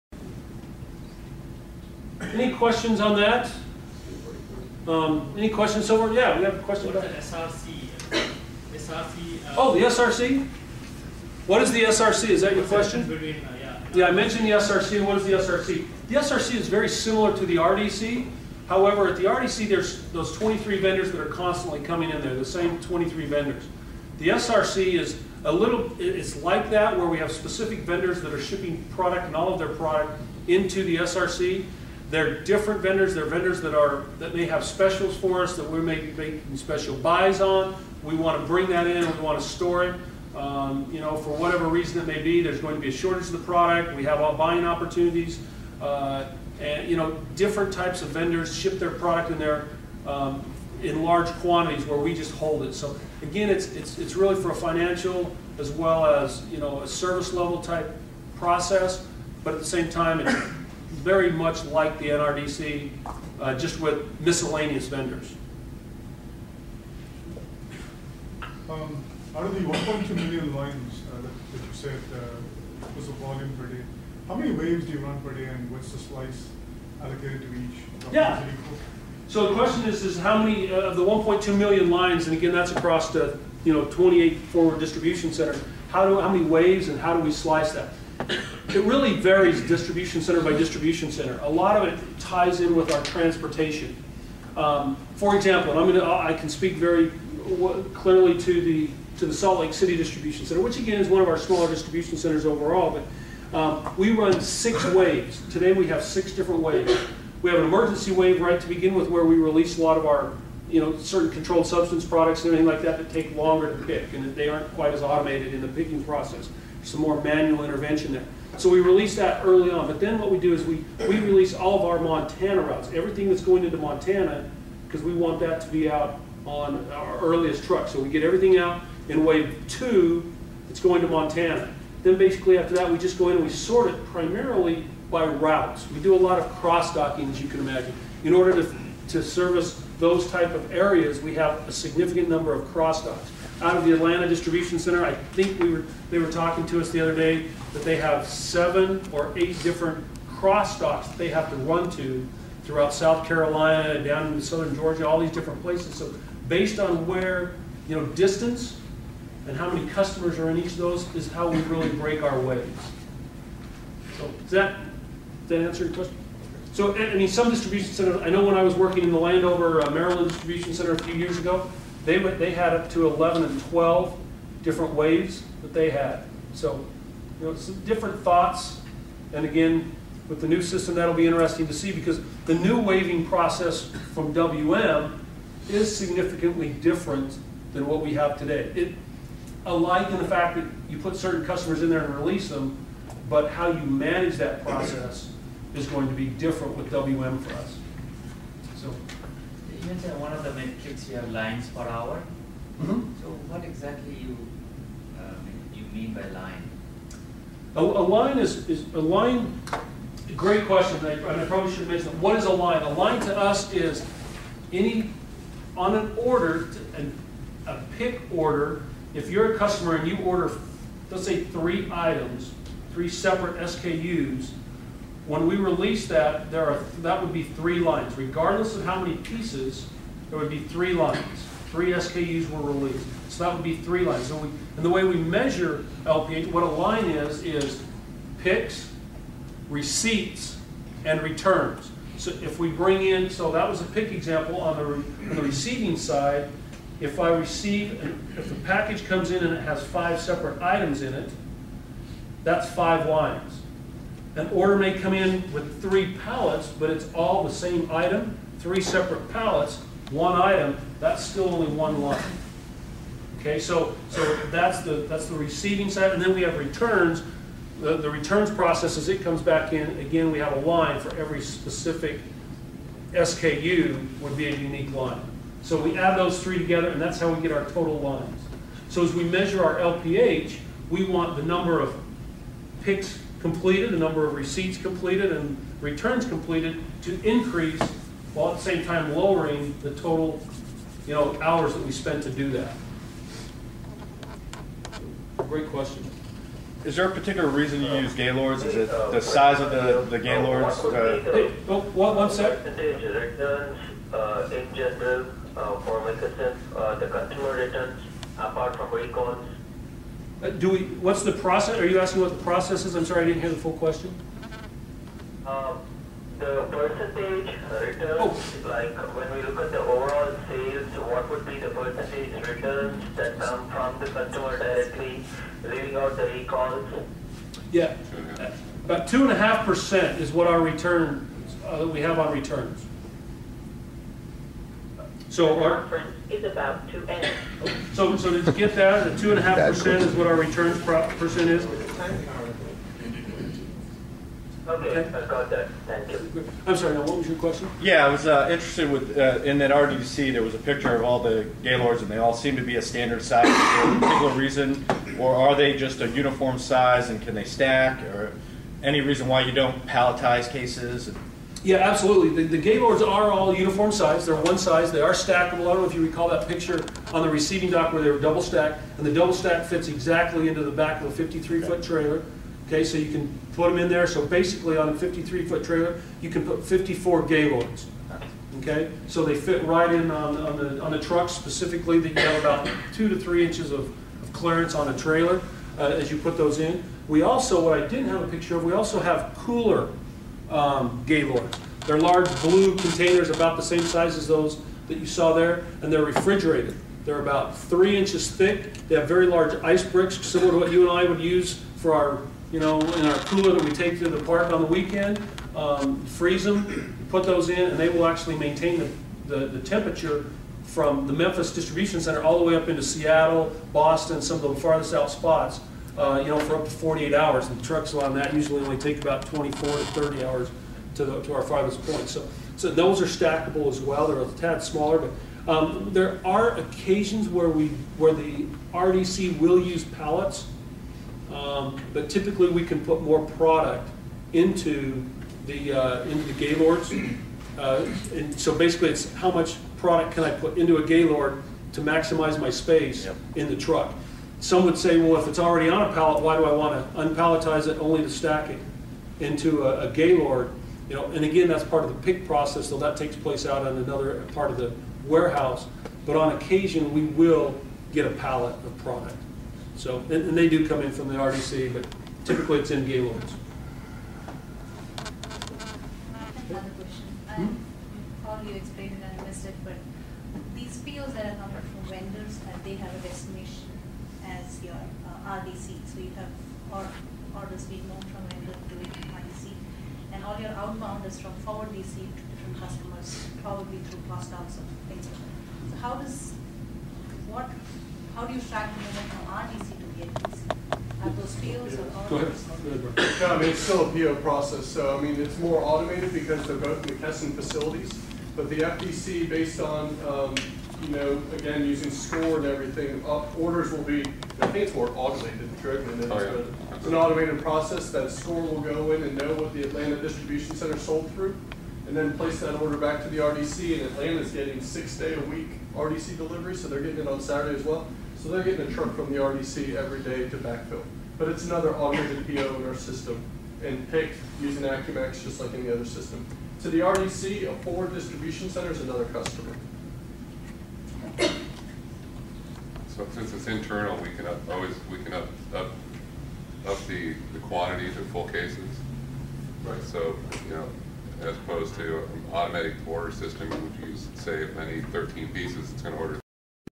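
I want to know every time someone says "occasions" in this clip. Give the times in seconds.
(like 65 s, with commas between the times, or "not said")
426 s, 456 s.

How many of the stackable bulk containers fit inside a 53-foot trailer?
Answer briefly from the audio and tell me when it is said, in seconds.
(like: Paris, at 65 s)
54, at 376 s.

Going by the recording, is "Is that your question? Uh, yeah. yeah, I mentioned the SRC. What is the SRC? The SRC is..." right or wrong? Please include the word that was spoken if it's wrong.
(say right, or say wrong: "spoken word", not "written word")
right.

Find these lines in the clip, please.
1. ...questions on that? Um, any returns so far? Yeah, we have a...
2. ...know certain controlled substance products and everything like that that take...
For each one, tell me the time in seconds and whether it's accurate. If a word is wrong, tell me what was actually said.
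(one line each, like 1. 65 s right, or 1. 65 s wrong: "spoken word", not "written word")
1. 2 s wrong: "questions", not "returns"
2. 110 s right.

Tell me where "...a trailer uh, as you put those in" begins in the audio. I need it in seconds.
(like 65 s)
384 s.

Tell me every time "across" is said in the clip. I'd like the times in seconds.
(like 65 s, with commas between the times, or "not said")
82 s.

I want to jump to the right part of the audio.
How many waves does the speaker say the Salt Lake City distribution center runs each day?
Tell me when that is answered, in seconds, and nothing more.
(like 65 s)
104 s.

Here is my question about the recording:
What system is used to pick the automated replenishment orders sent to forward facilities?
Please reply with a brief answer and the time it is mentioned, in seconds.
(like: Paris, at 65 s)
Acumax, at 524 s.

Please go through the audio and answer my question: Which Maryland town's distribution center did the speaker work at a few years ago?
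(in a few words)
Landover.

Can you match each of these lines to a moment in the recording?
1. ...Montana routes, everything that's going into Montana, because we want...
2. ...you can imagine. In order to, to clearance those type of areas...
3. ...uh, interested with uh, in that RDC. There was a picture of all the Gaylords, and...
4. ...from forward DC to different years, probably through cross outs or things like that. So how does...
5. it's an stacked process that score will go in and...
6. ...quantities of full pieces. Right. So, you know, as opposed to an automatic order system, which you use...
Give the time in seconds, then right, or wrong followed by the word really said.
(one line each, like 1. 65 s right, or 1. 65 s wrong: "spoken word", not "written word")
1. 121 s right
2. 137 s wrong: "service", not "clearance"
3. 348 s right
4. 481 s wrong: "customers", not "years"
5. 506 s wrong: "automated", not "stacked"
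6. 537 s wrong: "cases", not "pieces".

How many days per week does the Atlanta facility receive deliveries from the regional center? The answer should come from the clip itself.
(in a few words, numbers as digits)
6.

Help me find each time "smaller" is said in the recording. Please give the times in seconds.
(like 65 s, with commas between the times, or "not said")
101 s, 424 s.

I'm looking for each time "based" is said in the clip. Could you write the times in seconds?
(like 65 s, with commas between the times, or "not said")
156 s, 499 s.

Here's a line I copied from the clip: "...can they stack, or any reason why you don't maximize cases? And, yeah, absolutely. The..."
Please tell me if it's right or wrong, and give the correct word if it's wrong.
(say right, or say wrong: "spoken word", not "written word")
wrong: "palletize", not "maximize".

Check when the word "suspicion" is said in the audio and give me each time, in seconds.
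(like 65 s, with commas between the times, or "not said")
not said.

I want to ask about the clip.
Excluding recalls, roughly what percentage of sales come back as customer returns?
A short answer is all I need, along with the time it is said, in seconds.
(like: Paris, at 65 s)
2.5%, at 329 s.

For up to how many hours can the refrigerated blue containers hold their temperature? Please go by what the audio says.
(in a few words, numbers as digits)
48 hours.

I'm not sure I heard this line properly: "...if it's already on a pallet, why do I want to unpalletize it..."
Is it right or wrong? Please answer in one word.
right.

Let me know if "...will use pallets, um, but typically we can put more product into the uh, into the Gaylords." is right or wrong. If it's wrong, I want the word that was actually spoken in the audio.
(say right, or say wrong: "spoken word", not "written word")
right.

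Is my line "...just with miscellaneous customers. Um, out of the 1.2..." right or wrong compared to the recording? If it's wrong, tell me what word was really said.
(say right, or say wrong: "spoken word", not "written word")
wrong: "vendors", not "customers".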